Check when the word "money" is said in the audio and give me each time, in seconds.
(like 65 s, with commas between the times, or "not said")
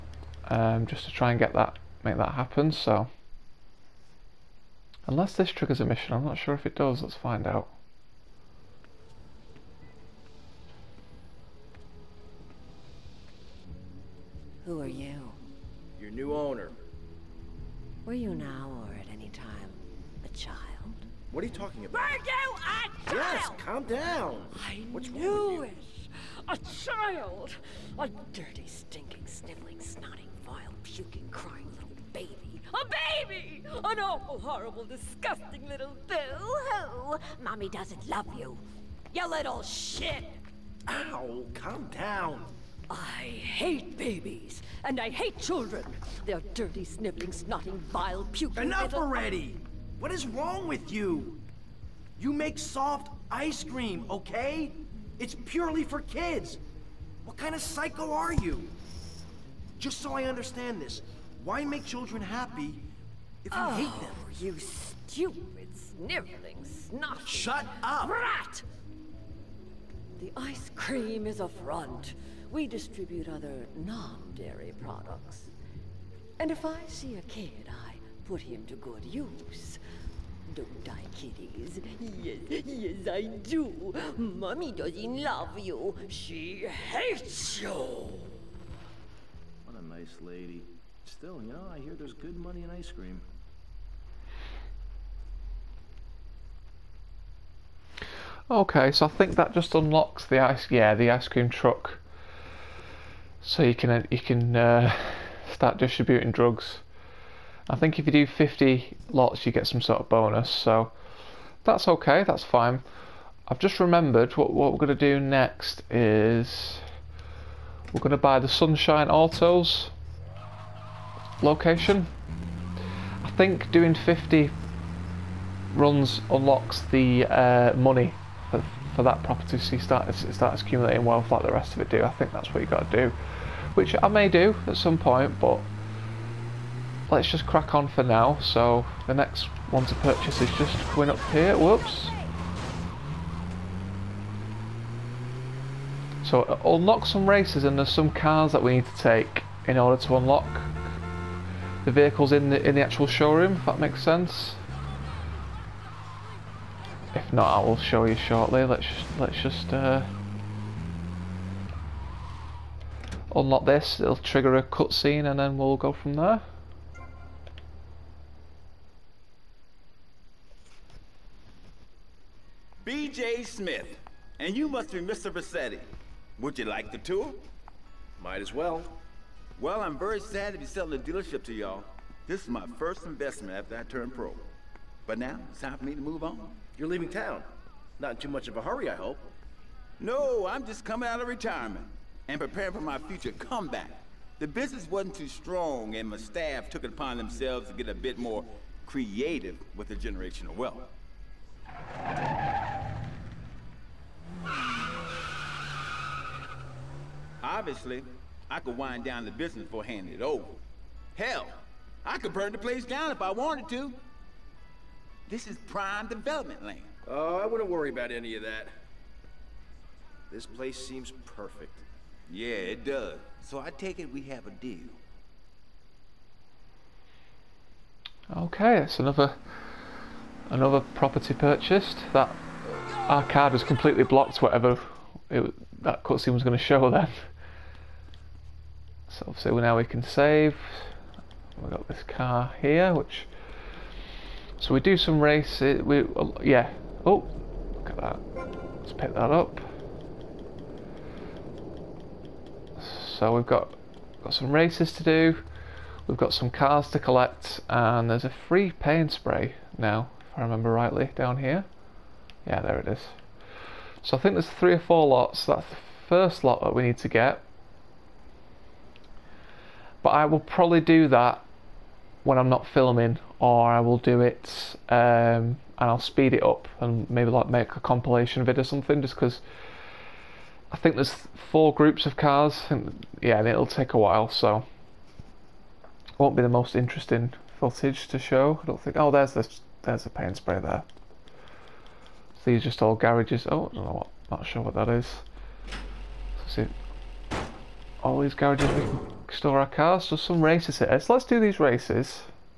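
92 s, 127 s.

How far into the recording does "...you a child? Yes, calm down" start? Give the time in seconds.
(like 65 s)
22 s.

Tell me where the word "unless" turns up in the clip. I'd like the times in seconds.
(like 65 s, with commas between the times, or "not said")
5 s.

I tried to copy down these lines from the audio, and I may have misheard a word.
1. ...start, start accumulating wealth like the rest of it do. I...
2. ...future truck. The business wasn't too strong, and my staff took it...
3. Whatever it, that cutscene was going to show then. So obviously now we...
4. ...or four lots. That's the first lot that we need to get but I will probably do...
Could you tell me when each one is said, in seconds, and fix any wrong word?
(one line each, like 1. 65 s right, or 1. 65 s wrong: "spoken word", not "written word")
1. 129 s right
2. 192 s wrong: "comeback", not "truck"
3. 234 s right
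4. 264 s right.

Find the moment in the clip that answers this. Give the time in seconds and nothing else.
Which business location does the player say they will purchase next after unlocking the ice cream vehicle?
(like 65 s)
118 s.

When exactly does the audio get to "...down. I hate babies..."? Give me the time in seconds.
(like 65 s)
41 s.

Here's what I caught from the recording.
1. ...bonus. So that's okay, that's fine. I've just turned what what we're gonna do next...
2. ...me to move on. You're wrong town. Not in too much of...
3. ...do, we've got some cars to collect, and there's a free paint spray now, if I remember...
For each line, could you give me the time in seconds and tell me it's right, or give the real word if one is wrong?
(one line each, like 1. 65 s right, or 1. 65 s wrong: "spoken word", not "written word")
1. 110 s wrong: "remembered", not "turned"
2. 185 s wrong: "leaving", not "wrong"
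3. 255 s right.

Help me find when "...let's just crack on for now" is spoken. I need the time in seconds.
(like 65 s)
137 s.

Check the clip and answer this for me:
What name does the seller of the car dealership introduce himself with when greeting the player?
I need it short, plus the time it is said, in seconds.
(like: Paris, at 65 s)
B.J. Smith, at 172 s.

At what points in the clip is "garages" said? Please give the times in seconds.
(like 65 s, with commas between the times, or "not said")
292 s, 298 s.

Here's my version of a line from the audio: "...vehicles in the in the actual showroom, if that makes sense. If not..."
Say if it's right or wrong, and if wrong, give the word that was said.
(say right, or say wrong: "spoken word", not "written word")
right.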